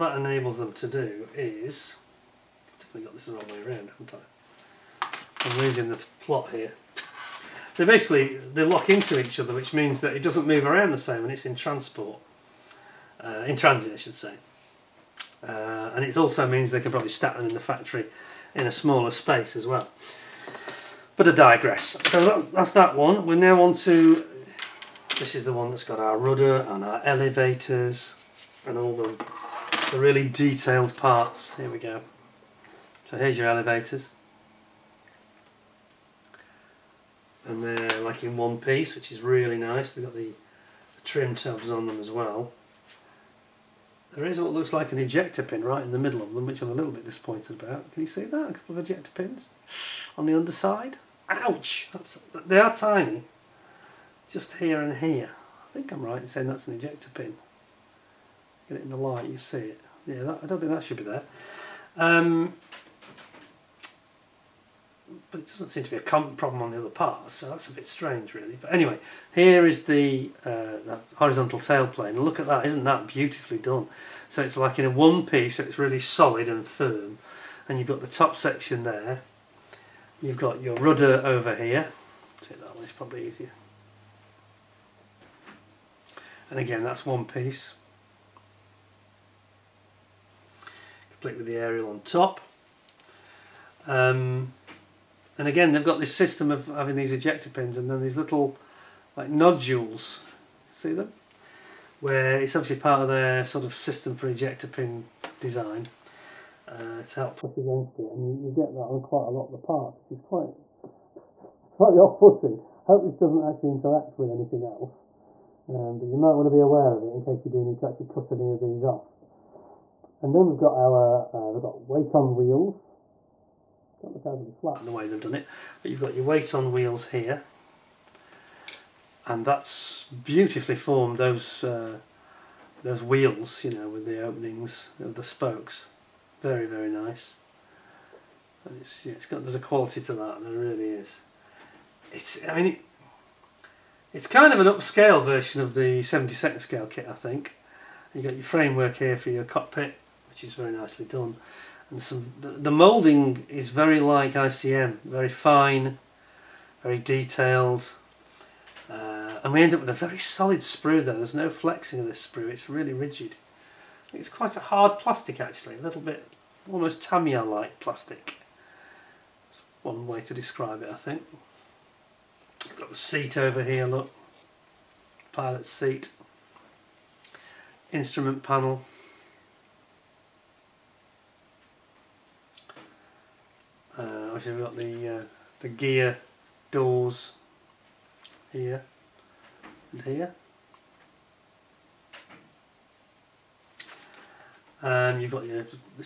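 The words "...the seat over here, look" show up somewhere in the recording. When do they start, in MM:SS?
02:52.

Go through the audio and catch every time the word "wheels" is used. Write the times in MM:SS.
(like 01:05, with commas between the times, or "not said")
02:02, 02:06, 02:13.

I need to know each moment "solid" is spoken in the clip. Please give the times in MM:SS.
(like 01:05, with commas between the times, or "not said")
01:15, 02:40.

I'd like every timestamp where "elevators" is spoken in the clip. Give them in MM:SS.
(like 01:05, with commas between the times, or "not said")
00:27, 00:33.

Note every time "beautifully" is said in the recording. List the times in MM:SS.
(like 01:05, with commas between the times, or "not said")
01:13, 02:10.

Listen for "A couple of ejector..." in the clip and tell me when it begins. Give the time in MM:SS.
00:48.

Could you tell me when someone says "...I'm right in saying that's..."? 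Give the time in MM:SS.
00:55.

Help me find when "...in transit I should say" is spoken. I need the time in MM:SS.
00:13.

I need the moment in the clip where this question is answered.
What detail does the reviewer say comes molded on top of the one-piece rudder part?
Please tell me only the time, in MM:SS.
01:31.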